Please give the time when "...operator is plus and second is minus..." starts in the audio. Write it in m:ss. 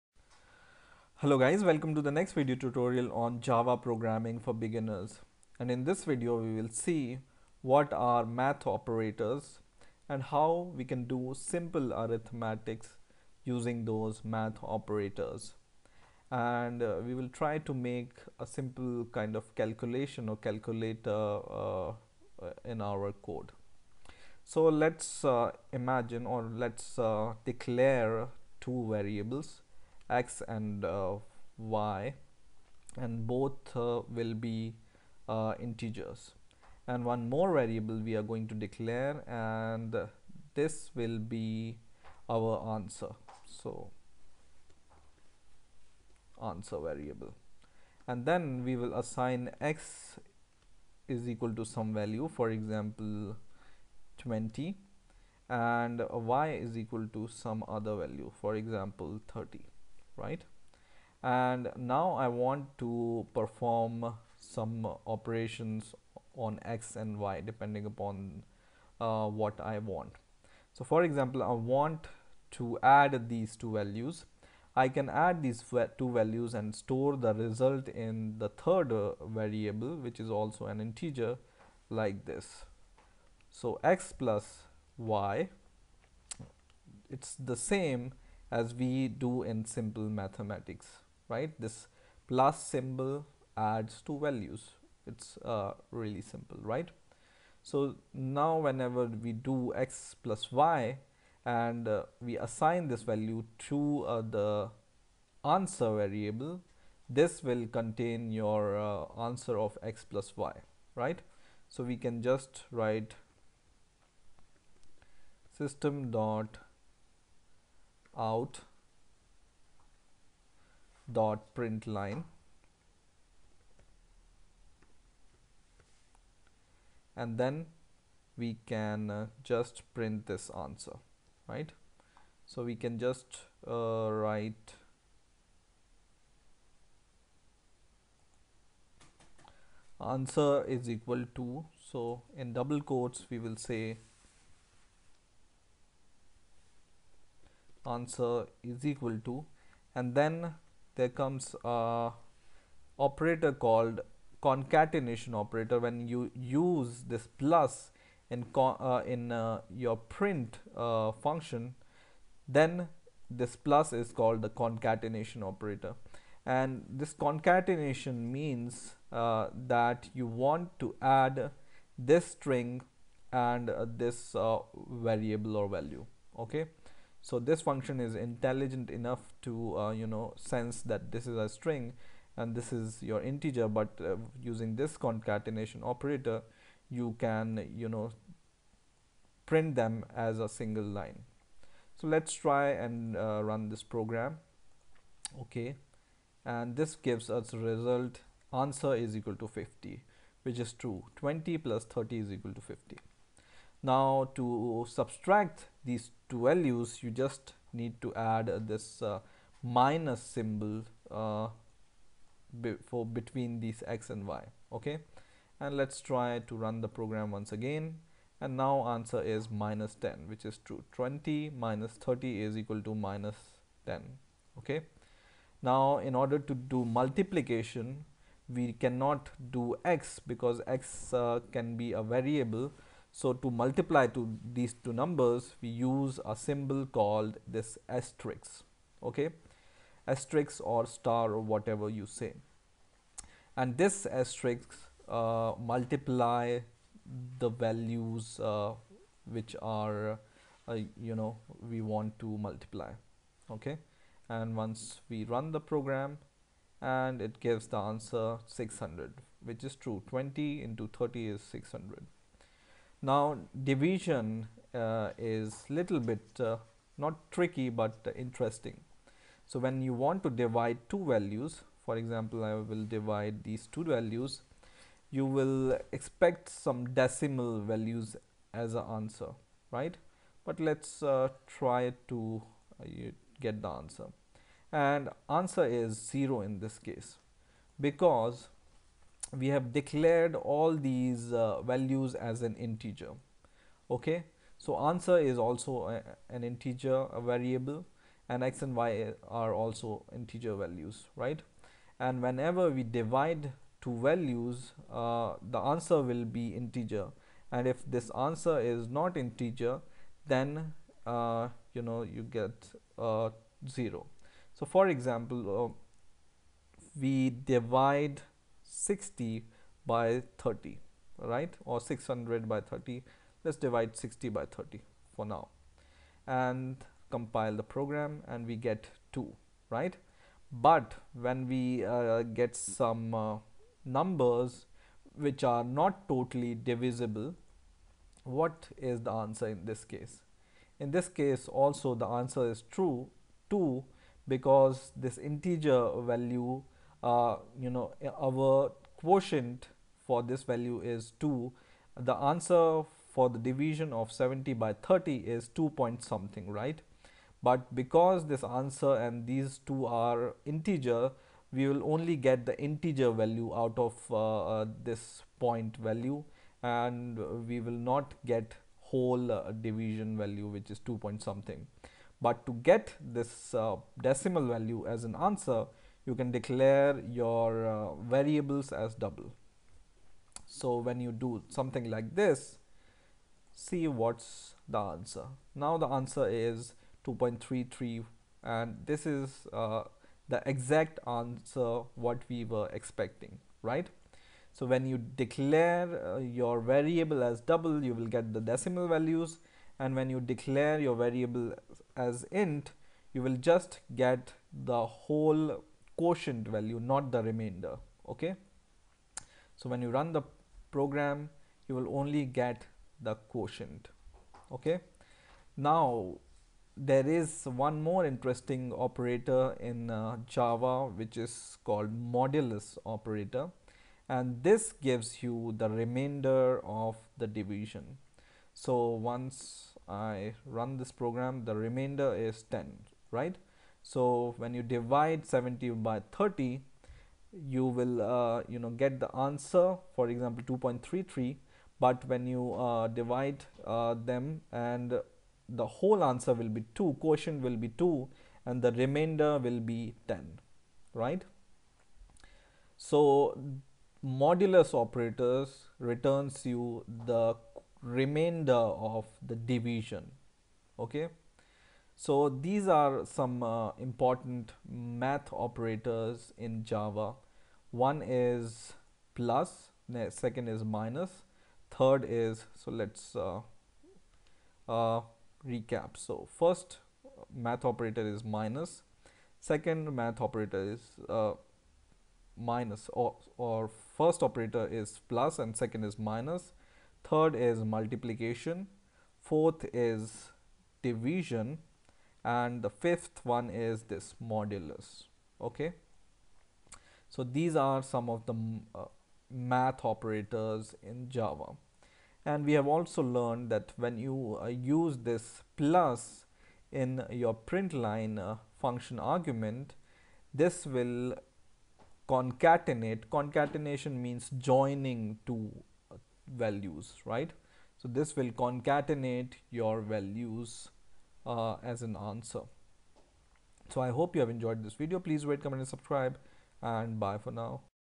8:04.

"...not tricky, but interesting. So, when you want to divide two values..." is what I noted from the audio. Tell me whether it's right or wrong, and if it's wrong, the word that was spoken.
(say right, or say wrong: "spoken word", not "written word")
right.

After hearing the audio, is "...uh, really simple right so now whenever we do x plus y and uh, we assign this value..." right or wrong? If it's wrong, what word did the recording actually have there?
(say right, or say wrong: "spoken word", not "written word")
right.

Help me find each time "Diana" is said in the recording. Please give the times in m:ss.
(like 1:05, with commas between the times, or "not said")
not said.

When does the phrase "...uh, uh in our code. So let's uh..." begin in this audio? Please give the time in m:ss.
0:21.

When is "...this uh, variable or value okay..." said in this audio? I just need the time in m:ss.
2:53.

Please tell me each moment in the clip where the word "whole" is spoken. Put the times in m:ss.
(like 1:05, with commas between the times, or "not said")
6:08, 6:44, 7:25.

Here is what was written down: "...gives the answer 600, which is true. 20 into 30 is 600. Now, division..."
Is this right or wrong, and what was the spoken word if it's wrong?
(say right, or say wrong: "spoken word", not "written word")
right.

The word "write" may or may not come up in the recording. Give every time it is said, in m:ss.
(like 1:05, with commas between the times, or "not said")
1:52, 2:14.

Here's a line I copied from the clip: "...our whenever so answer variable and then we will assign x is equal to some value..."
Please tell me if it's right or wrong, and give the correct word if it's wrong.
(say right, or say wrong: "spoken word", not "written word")
wrong: "answer", not "whenever".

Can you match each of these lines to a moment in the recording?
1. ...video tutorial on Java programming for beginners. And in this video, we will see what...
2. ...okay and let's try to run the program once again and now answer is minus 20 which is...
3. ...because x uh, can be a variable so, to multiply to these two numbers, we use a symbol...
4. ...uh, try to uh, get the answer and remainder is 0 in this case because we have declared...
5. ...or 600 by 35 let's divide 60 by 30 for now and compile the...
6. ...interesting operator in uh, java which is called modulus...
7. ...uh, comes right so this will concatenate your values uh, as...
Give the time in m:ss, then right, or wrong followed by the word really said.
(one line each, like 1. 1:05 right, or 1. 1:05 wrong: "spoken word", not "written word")
1. 0:02 right
2. 3:34 wrong: "10", not "20"
3. 3:50 right
4. 4:41 wrong: "answer", not "remainder"
5. 5:21 wrong: "30", not "35"
6. 6:58 right
7. 8:35 wrong: "values", not "comes".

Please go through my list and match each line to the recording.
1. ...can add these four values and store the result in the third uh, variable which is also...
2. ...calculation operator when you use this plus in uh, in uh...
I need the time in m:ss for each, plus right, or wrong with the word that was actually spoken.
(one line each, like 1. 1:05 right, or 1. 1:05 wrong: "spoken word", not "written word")
1. 1:14 wrong: "two", not "four"
2. 2:34 wrong: "concatenation", not "calculation".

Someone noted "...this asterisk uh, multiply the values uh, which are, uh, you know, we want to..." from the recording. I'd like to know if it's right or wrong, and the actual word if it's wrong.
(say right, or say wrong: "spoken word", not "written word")
right.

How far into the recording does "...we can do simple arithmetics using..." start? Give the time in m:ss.
0:10.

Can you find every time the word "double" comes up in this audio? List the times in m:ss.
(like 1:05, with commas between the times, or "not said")
2:22, 6:18, 6:37.